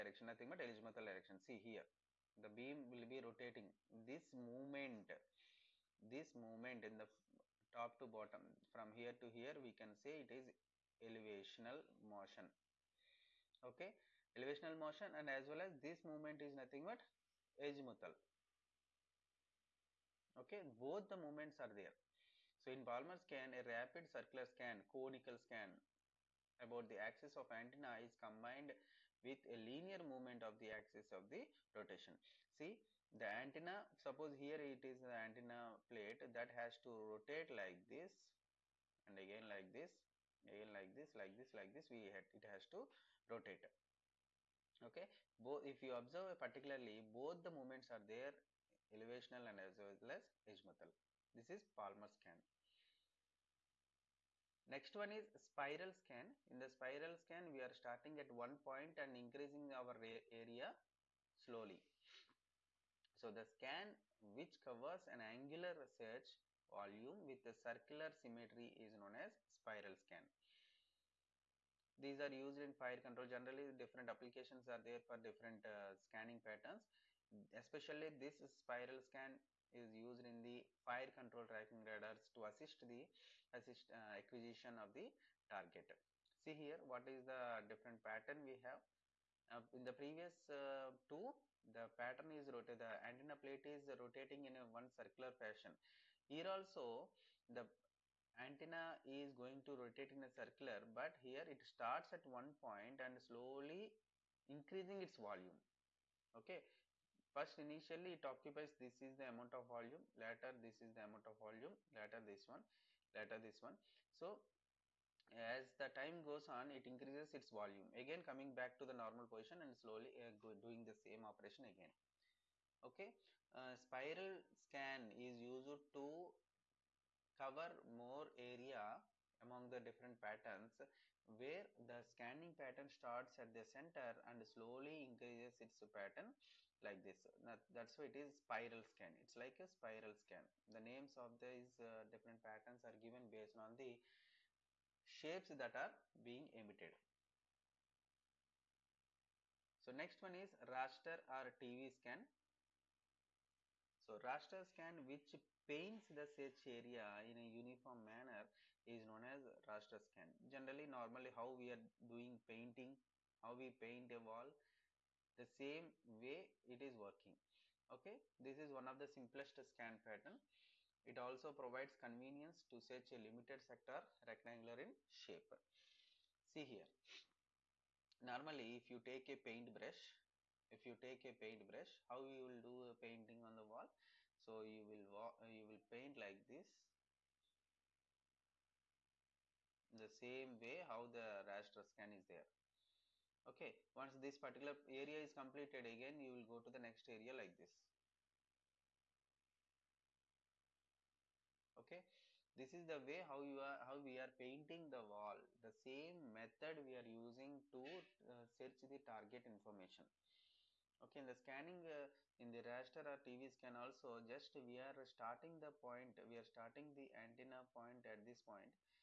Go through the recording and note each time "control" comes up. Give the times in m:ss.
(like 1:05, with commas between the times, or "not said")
1:13, 1:21.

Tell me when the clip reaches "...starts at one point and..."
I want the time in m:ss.
1:41.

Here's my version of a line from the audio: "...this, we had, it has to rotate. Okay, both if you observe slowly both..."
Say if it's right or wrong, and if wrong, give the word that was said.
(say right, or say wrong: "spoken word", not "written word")
wrong: "particularly", not "slowly".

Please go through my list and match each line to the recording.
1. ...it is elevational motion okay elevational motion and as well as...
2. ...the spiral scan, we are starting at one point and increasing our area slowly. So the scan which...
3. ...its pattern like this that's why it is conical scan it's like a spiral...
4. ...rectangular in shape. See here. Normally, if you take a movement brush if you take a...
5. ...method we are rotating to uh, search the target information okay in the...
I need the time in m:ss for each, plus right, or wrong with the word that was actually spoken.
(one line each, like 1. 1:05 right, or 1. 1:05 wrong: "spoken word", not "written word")
1. 0:10 right
2. 0:56 right
3. 2:15 wrong: "spiral", not "conical"
4. 2:54 wrong: "paint", not "movement"
5. 3:26 wrong: "using", not "rotating".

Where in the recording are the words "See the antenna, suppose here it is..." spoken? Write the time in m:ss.
0:32.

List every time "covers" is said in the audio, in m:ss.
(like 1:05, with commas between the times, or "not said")
1:04, 2:07.